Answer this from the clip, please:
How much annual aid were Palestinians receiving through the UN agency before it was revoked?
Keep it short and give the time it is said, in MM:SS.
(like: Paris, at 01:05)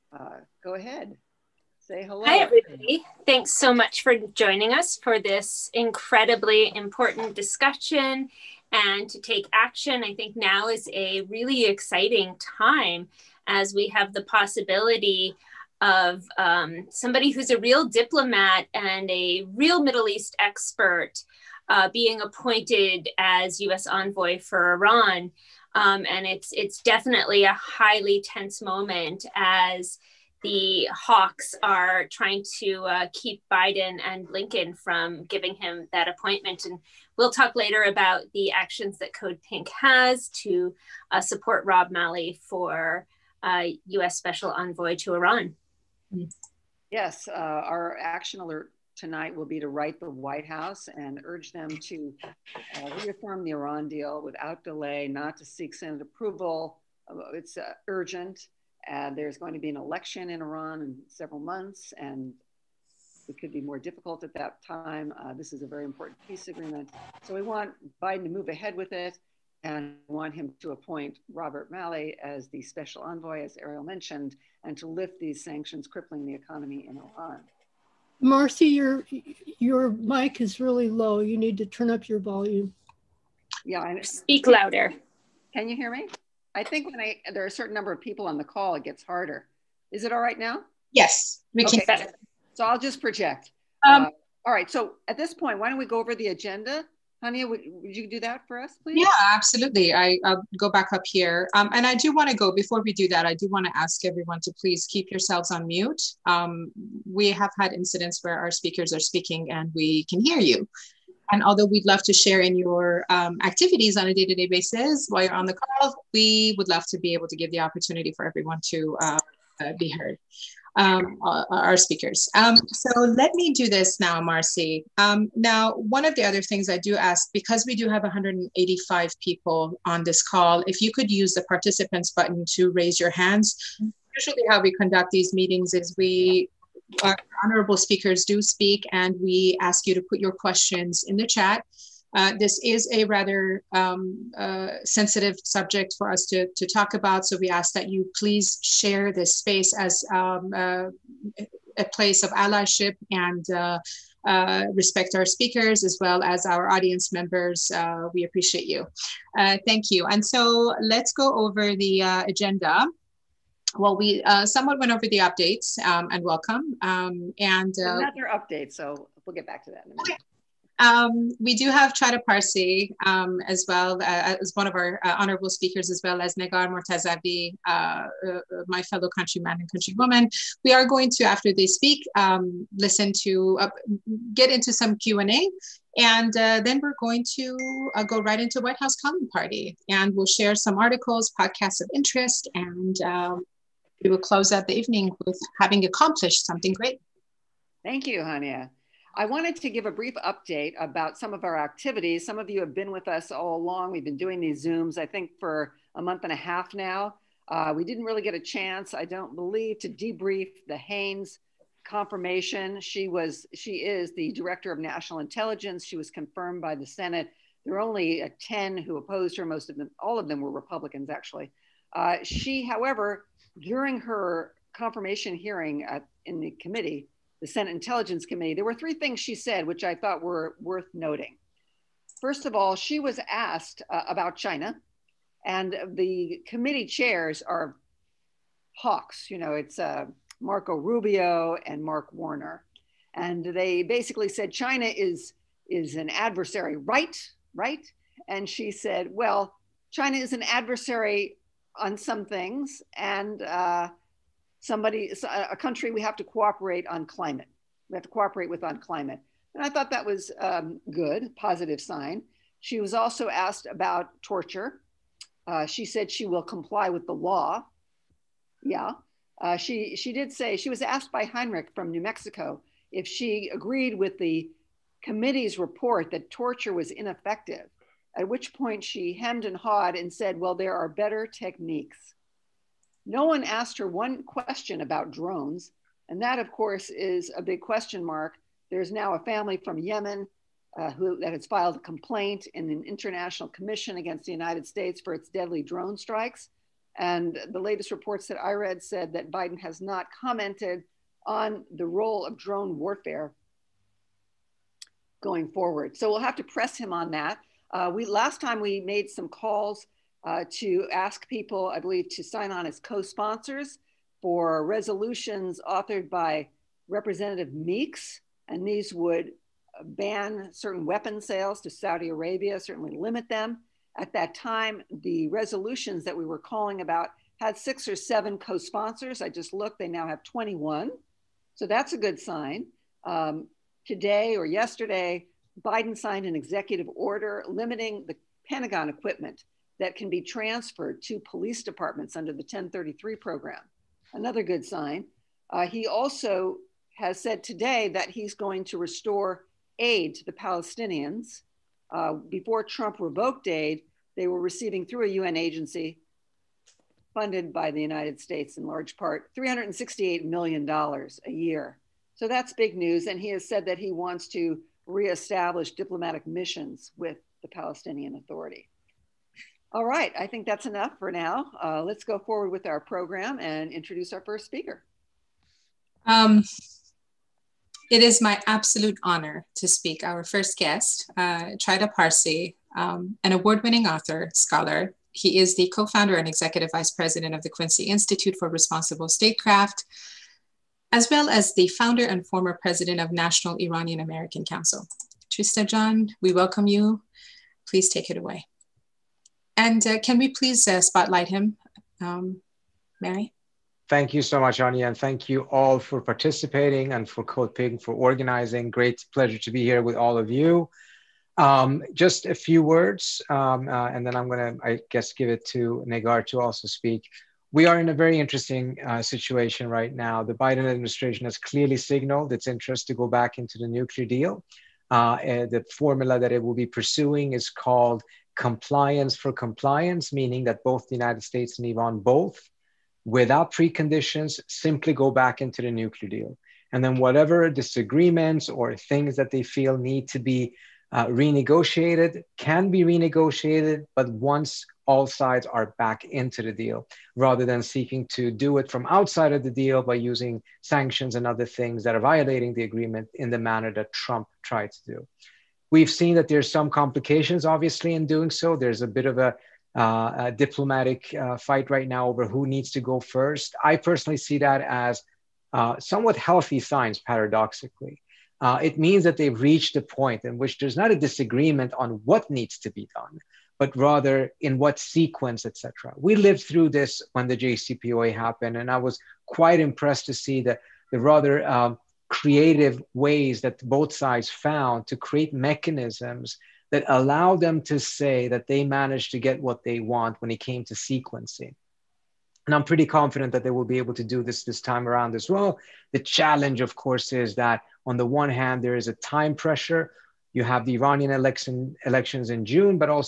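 $368 million, at 05:59.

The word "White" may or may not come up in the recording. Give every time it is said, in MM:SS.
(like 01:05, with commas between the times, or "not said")
00:50, 03:08.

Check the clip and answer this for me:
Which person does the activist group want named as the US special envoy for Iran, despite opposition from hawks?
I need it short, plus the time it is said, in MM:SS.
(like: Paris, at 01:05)
Rob Malley, at 00:41.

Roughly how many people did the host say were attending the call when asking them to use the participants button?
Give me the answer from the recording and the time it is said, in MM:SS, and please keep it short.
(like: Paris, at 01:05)
185, at 02:08.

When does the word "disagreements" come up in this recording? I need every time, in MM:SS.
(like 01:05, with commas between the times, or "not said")
07:17, 07:50.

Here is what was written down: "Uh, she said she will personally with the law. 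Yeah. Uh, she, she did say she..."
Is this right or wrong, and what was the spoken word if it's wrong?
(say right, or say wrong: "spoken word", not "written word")
wrong: "comply", not "personally".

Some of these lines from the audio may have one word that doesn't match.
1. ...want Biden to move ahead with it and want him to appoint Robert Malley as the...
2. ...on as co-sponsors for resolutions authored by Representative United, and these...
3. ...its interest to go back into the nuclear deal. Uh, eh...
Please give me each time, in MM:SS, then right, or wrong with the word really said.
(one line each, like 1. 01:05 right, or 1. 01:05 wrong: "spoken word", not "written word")
1. 01:07 right
2. 05:12 wrong: "Meeks", not "United"
3. 07:02 right.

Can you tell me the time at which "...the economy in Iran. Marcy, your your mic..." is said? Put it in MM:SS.
01:16.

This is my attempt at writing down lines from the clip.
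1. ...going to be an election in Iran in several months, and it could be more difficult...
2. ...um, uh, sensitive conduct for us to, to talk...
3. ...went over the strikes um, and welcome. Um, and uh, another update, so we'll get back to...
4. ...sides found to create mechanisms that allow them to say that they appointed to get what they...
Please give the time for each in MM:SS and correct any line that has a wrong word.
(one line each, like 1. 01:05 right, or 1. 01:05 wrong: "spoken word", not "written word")
1. 00:59 right
2. 02:23 wrong: "subject", not "conduct"
3. 02:44 wrong: "updates", not "strikes"
4. 08:03 wrong: "managed", not "appointed".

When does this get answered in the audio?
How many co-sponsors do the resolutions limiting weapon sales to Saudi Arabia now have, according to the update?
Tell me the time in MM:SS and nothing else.
05:30.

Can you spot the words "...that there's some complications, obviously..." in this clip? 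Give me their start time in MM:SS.
07:36.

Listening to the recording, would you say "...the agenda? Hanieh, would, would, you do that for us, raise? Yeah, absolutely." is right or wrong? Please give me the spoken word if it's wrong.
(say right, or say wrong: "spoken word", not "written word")
wrong: "please", not "raise".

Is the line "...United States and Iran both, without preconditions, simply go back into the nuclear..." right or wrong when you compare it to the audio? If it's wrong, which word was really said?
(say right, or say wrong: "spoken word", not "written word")
right.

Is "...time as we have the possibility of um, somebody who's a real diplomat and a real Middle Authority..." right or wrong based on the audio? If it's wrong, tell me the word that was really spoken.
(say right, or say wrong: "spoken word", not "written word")
wrong: "East", not "Authority".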